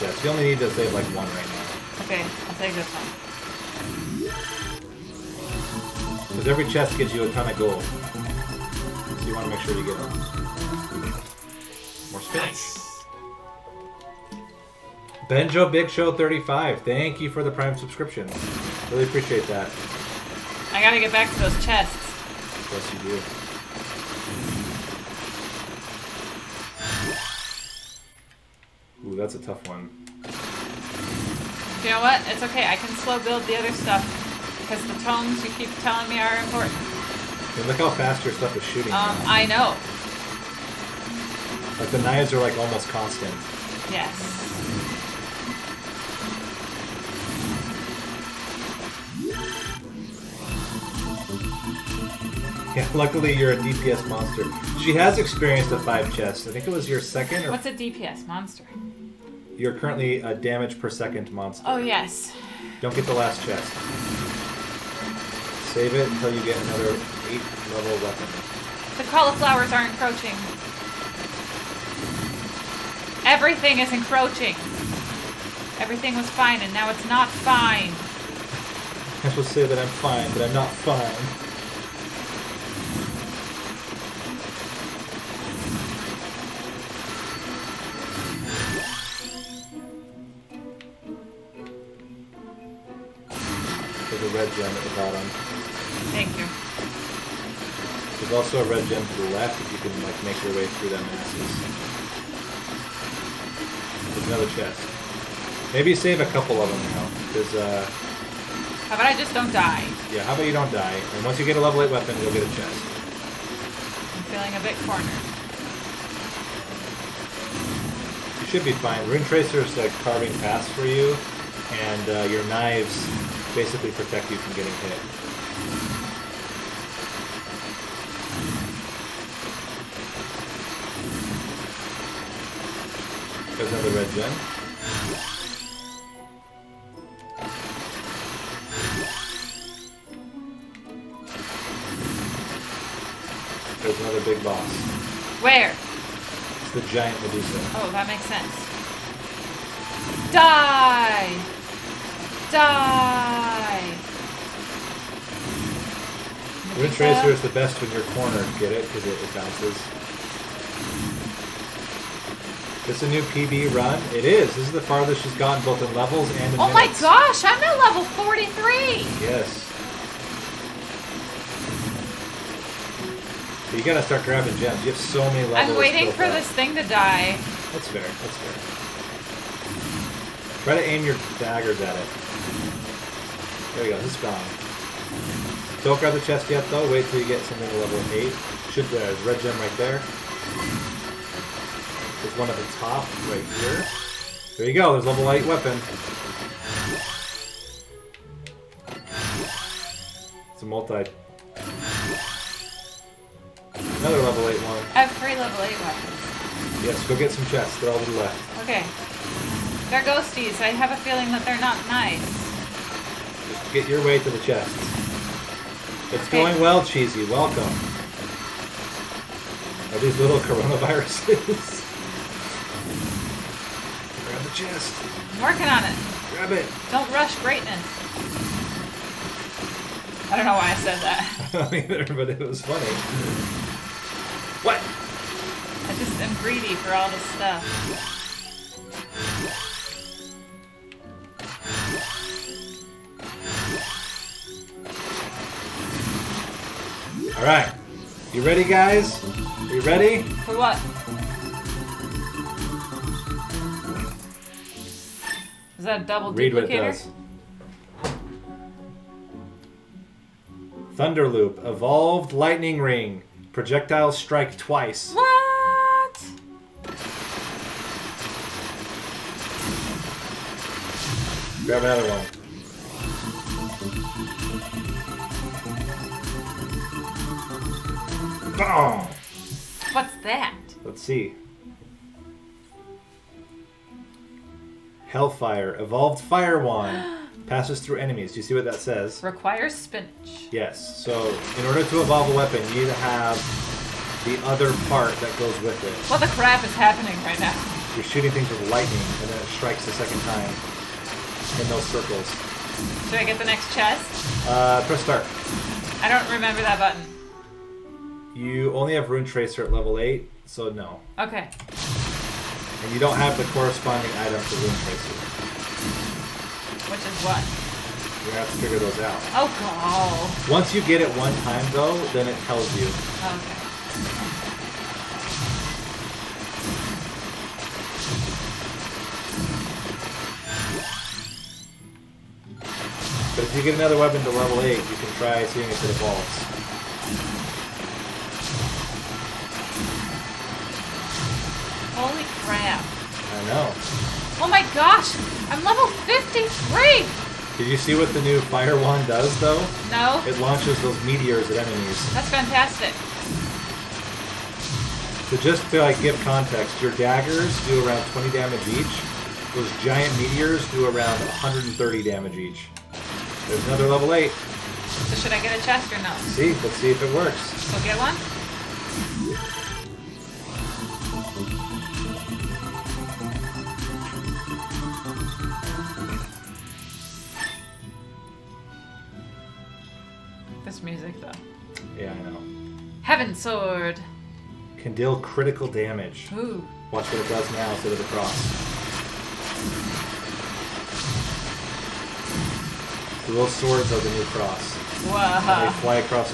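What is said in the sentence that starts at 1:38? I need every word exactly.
There's also a red gem to the left if you can like make your way through that masses.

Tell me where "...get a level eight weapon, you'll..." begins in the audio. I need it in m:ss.
1:51.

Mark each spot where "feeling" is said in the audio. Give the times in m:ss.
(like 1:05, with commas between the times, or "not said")
1:54, 3:30.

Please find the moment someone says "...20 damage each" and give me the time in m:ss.
5:58.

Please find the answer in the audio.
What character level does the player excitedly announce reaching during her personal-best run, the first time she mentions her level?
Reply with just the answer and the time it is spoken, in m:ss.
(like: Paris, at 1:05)
43, at 2:47.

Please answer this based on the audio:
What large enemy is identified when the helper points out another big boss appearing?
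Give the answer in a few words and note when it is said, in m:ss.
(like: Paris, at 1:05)
Giant Medusa, at 2:26.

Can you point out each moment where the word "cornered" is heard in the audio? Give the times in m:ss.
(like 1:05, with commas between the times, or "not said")
1:54, 2:38.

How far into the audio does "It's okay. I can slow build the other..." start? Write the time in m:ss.
0:32.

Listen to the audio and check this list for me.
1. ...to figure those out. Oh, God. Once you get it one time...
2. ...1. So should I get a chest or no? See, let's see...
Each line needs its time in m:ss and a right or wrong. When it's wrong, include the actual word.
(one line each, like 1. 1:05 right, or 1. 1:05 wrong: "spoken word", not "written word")
1. 5:18 right
2. 6:04 wrong: "8", not "1".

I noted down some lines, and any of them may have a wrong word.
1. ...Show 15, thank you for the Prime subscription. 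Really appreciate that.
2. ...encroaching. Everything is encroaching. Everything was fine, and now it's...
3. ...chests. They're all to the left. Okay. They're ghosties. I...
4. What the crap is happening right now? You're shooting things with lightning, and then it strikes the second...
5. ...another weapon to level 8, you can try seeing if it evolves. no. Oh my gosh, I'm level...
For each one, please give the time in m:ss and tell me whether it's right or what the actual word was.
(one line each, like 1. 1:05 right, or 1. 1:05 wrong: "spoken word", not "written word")
1. 0:15 wrong: "35", not "15"
2. 1:09 right
3. 3:27 right
4. 4:56 right
5. 5:33 right.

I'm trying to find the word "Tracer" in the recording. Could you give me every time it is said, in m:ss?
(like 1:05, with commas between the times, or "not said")
1:59, 2:36, 5:09, 5:14.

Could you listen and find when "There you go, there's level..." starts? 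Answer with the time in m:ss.
3:14.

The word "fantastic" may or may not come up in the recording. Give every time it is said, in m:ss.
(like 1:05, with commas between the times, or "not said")
5:52.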